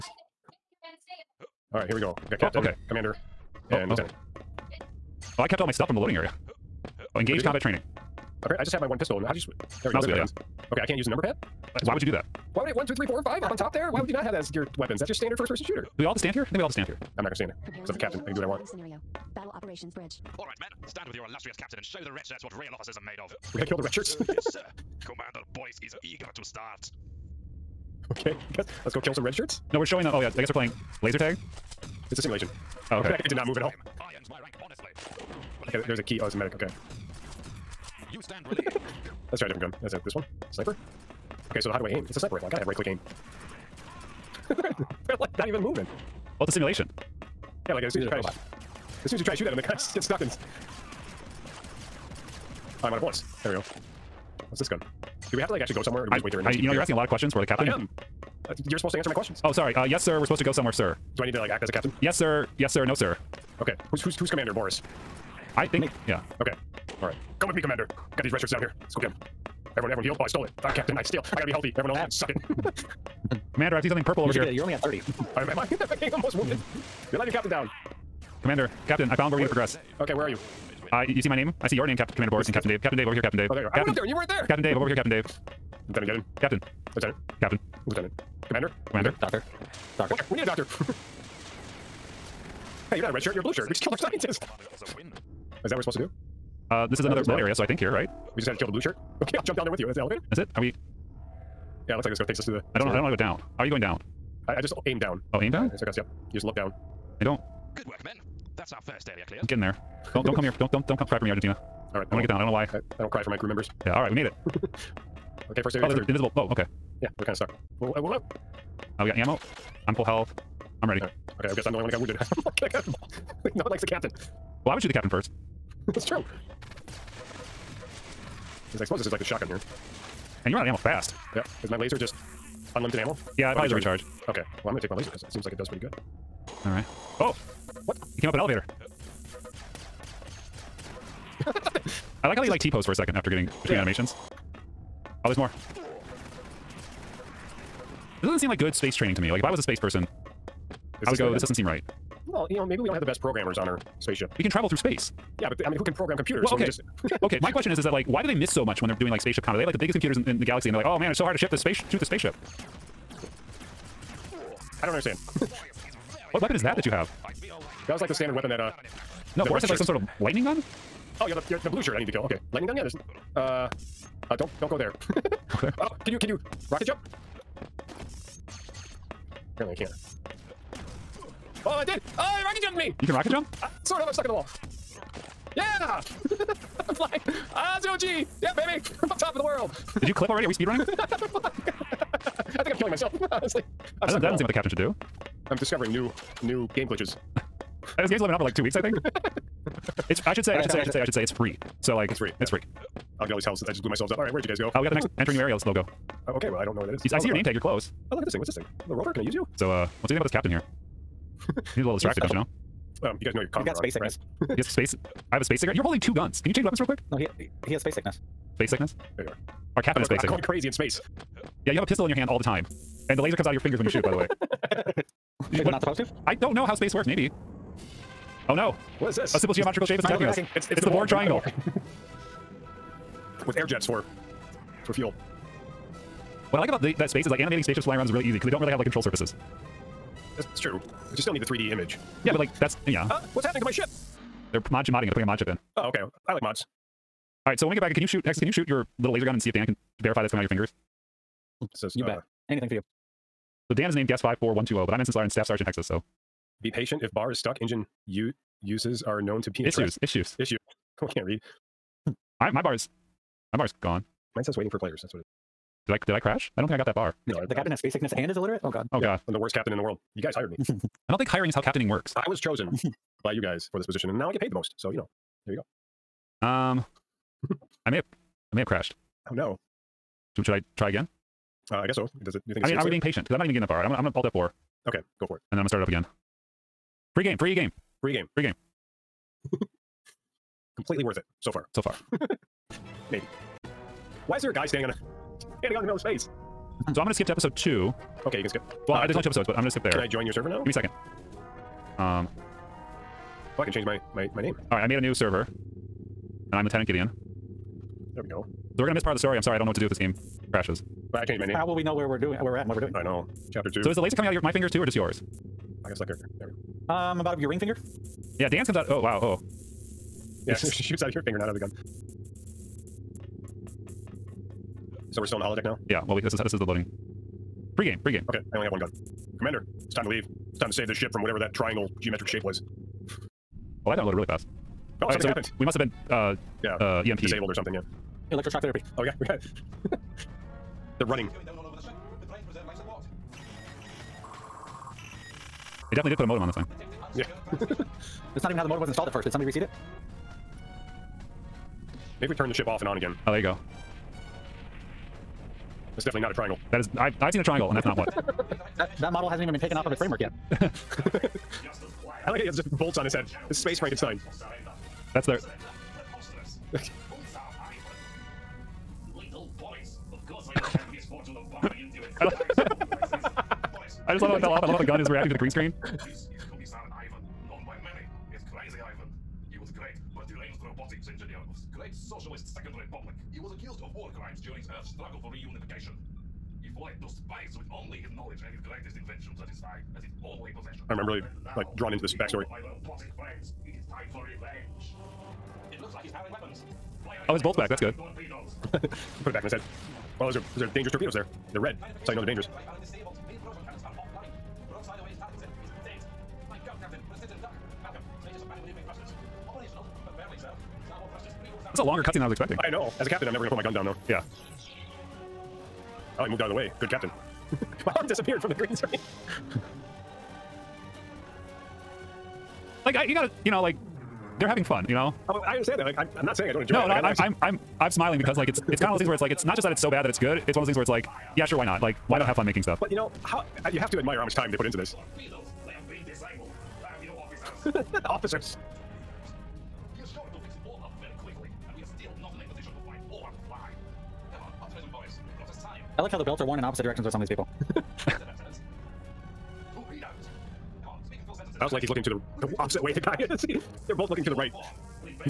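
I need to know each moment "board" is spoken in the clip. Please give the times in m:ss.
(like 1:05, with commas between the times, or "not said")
not said.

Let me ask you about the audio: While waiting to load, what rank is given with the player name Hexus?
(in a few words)
Staff Sergeant.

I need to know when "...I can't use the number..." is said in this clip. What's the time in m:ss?
0:10.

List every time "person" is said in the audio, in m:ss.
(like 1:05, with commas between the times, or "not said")
0:15, 2:29.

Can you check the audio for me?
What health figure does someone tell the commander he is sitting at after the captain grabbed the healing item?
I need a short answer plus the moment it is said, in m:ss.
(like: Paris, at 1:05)
30, at 1:14.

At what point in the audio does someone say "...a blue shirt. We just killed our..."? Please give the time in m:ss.
1:33.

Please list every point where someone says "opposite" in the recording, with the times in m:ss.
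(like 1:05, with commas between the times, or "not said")
7:26, 7:32.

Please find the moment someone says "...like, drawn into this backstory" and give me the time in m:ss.
6:31.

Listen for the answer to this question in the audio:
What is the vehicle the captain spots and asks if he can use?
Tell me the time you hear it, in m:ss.
3:28.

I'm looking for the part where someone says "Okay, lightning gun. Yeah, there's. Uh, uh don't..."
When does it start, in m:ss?
2:52.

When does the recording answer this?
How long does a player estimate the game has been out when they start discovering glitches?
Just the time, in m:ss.
3:18.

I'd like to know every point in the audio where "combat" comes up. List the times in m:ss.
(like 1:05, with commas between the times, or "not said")
0:07, 2:39.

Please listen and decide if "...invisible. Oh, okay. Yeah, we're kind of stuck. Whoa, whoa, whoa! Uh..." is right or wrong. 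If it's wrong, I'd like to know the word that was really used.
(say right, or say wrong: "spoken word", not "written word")
right.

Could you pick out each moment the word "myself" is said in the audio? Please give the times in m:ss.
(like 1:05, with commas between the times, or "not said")
3:12, 3:23.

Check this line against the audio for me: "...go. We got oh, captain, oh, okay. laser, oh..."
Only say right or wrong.
wrong.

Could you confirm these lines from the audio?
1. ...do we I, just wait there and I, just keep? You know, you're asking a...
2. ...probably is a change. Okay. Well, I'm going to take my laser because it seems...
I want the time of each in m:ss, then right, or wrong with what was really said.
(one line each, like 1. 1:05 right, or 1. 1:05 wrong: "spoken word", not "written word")
1. 0:56 right
2. 2:13 wrong: "recharge", not "change".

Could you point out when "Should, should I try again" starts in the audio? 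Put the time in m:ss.
4:40.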